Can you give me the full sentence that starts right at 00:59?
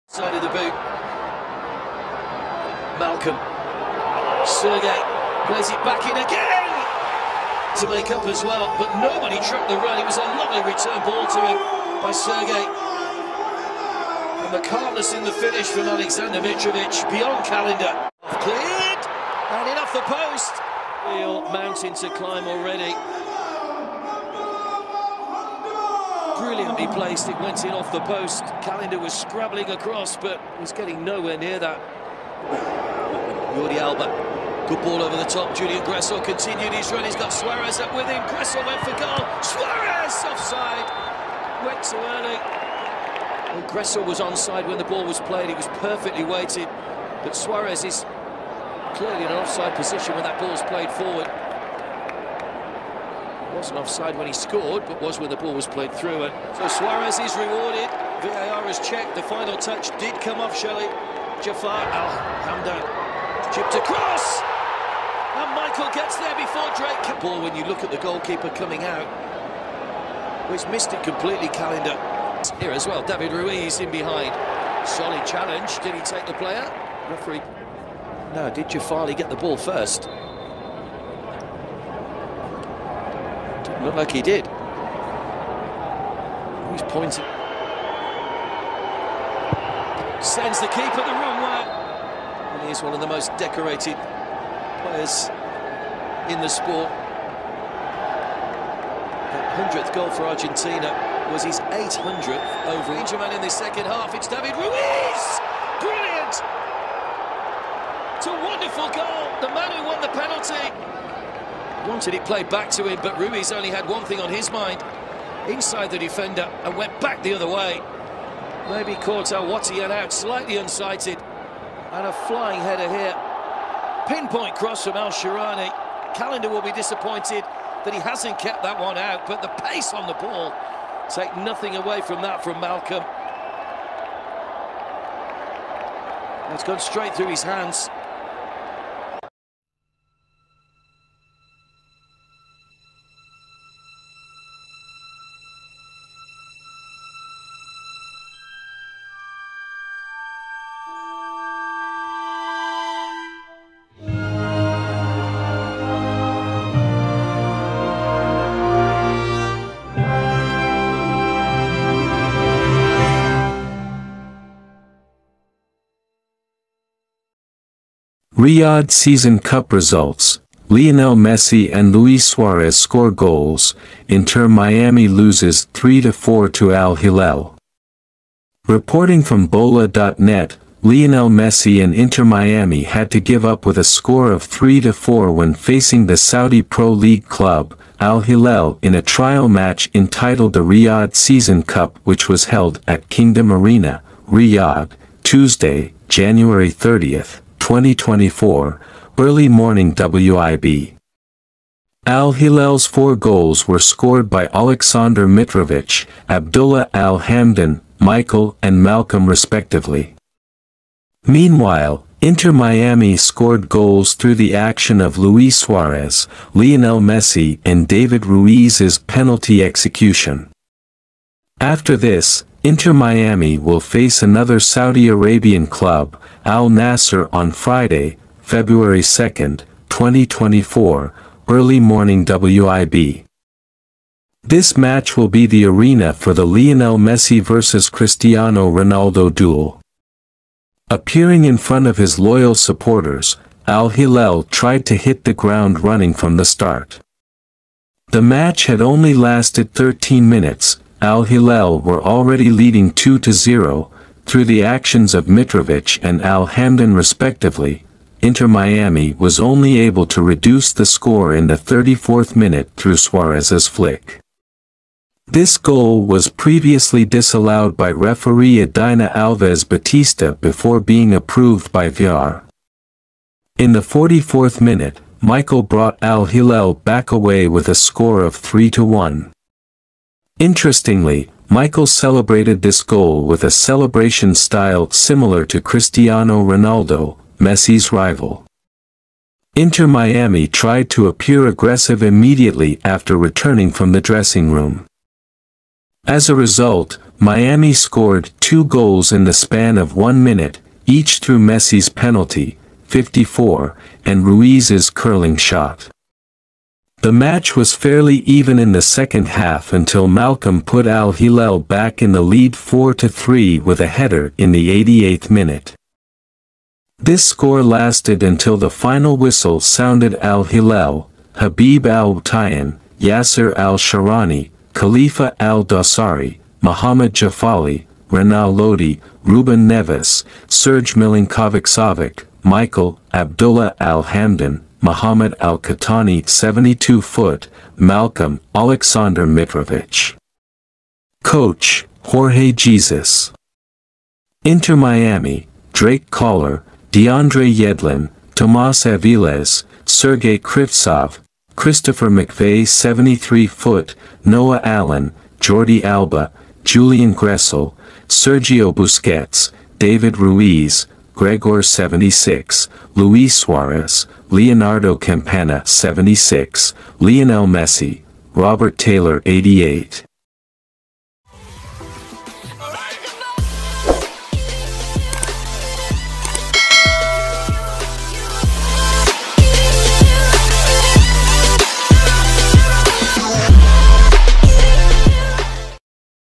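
The final touch did come off Shelley.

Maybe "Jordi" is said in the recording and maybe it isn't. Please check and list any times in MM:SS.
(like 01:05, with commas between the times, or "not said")
00:33, 05:55.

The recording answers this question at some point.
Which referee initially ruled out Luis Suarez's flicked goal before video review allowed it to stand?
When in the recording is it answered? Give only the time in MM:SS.
04:28.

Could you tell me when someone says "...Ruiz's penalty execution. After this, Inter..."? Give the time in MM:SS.
03:38.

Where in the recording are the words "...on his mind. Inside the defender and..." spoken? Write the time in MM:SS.
01:54.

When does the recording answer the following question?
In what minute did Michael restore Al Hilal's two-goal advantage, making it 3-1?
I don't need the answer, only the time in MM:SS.
04:33.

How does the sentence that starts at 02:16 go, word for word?
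it has gone straight through his hands.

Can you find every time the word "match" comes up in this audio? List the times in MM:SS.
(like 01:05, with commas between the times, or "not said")
03:09, 03:54, 04:08, 05:07.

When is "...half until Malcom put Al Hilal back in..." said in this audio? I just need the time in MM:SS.
05:09.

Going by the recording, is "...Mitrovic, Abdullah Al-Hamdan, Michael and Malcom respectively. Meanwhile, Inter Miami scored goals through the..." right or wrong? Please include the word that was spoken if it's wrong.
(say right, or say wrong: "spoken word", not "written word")
right.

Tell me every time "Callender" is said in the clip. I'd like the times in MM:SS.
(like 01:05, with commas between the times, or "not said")
00:17, 00:28, 01:11, 02:06.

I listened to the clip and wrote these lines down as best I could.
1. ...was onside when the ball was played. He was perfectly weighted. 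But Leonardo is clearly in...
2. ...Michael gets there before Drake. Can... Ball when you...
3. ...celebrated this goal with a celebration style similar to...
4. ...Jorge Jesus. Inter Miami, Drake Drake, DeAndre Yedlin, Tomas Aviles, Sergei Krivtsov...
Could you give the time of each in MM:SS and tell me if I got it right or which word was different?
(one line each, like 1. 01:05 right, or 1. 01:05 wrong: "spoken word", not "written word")
1. 00:44 wrong: "Suarez", not "Leonardo"
2. 01:05 right
3. 04:41 right
4. 05:42 wrong: "Collar", not "Drake".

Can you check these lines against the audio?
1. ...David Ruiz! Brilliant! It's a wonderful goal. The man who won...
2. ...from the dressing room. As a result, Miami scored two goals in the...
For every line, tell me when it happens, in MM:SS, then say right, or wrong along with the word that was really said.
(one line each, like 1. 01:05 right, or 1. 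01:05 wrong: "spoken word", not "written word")
1. 01:44 right
2. 04:53 right.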